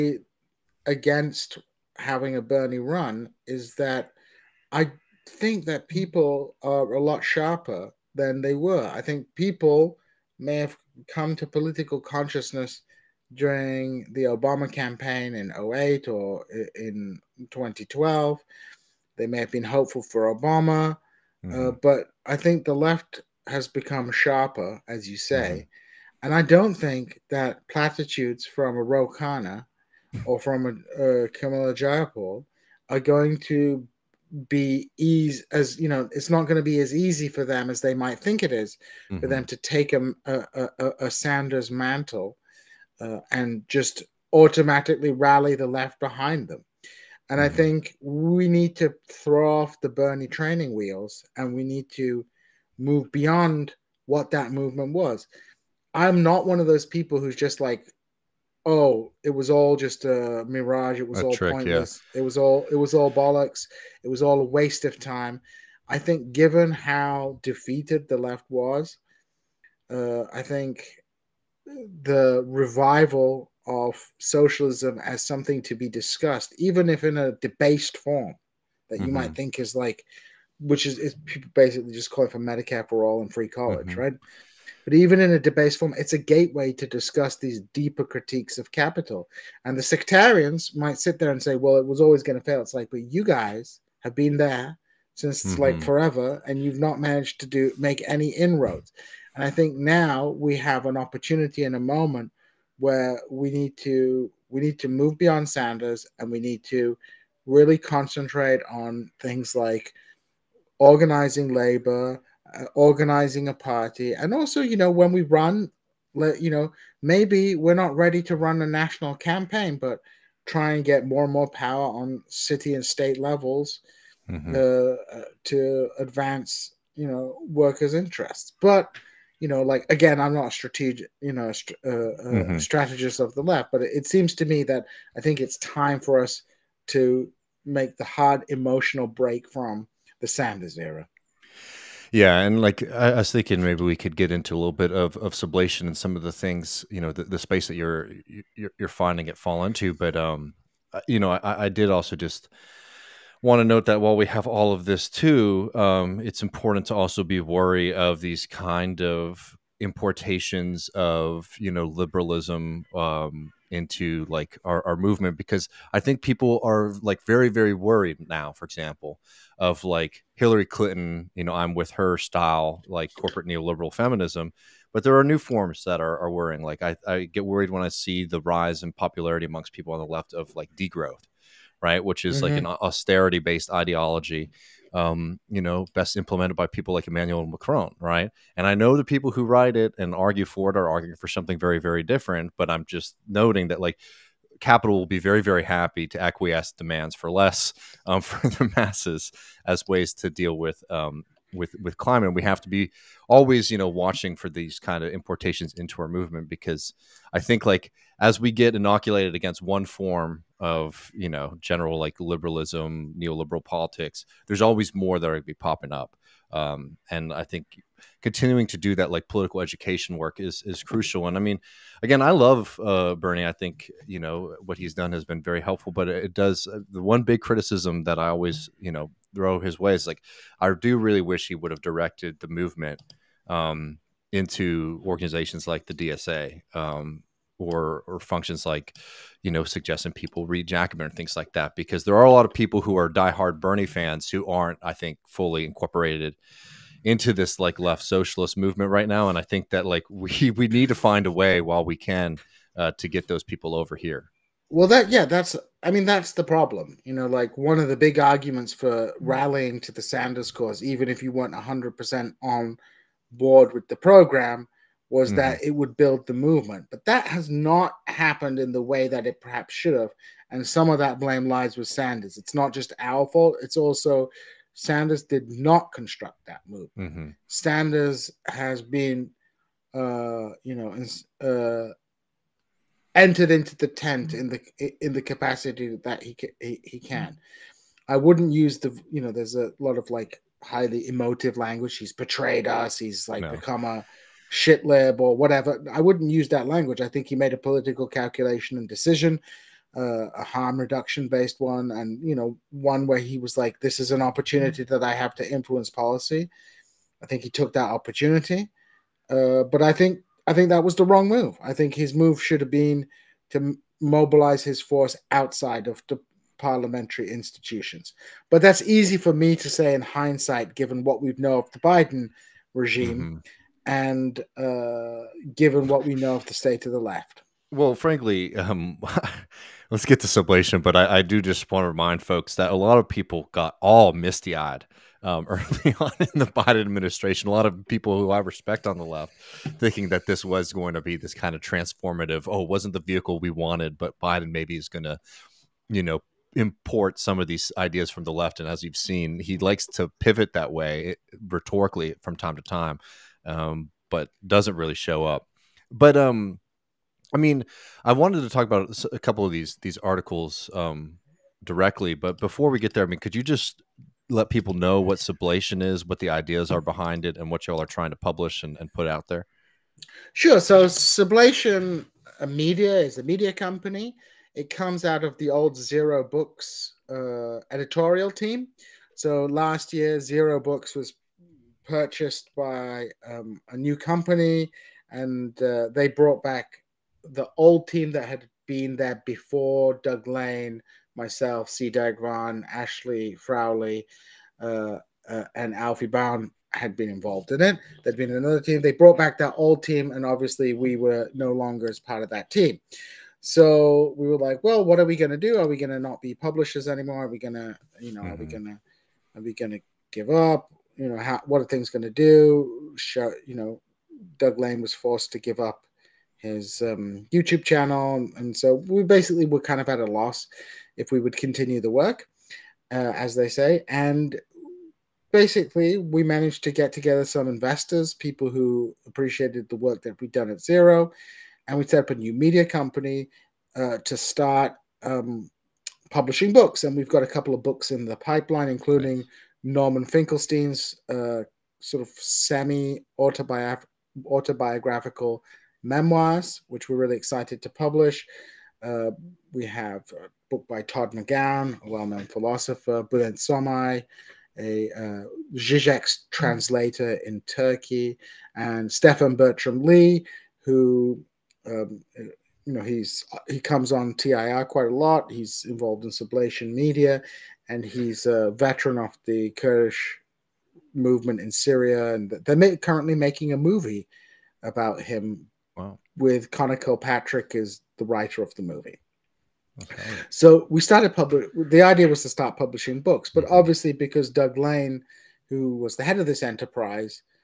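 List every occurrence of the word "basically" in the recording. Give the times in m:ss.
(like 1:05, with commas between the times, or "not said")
1:21, 6:59, 7:05.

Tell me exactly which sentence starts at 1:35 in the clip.
like forever, and you've not managed to do make any inroads.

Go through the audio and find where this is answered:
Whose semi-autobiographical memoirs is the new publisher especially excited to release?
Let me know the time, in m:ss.
7:19.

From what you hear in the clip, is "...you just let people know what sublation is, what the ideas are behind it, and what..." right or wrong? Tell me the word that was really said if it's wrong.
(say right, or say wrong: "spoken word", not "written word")
right.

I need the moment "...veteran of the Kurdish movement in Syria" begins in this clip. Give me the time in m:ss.
7:48.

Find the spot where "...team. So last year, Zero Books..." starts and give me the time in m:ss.
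6:18.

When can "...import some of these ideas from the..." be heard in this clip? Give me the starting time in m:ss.
5:46.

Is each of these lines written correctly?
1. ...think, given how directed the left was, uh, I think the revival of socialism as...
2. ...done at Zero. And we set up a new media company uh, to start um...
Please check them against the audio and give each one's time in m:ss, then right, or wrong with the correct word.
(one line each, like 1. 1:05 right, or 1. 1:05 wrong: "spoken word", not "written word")
1. 1:05 wrong: "defeated", not "directed"
2. 7:10 right.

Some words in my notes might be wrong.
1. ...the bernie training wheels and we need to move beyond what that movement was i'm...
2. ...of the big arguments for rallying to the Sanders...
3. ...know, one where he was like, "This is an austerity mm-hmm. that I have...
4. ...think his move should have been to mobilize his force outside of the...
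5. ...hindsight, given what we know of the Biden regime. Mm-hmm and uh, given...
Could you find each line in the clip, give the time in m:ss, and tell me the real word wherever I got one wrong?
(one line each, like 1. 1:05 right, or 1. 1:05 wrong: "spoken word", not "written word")
1. 0:49 right
2. 4:17 right
3. 5:02 wrong: "opportunity", not "austerity"
4. 5:11 right
5. 5:20 right.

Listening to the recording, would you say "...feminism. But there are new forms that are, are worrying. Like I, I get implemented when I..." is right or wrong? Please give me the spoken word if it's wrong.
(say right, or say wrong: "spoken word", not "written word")
wrong: "worried", not "implemented".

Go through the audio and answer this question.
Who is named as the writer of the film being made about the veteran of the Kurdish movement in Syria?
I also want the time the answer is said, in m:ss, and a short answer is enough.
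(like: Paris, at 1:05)
Connor Patrick, at 7:56.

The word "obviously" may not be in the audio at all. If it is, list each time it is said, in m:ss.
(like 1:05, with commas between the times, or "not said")
6:40, 8:03.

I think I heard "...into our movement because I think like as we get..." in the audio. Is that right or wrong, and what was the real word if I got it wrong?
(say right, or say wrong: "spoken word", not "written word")
right.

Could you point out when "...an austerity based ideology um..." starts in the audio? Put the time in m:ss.
3:02.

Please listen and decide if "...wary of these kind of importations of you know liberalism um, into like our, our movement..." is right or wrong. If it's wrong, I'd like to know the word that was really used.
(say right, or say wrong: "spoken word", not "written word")
right.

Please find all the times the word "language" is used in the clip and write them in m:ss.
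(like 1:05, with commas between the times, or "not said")
4:51, 4:56.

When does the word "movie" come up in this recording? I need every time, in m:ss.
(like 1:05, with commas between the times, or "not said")
7:53, 7:58.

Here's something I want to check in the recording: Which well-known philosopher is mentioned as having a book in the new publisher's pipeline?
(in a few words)
Todd McGowan.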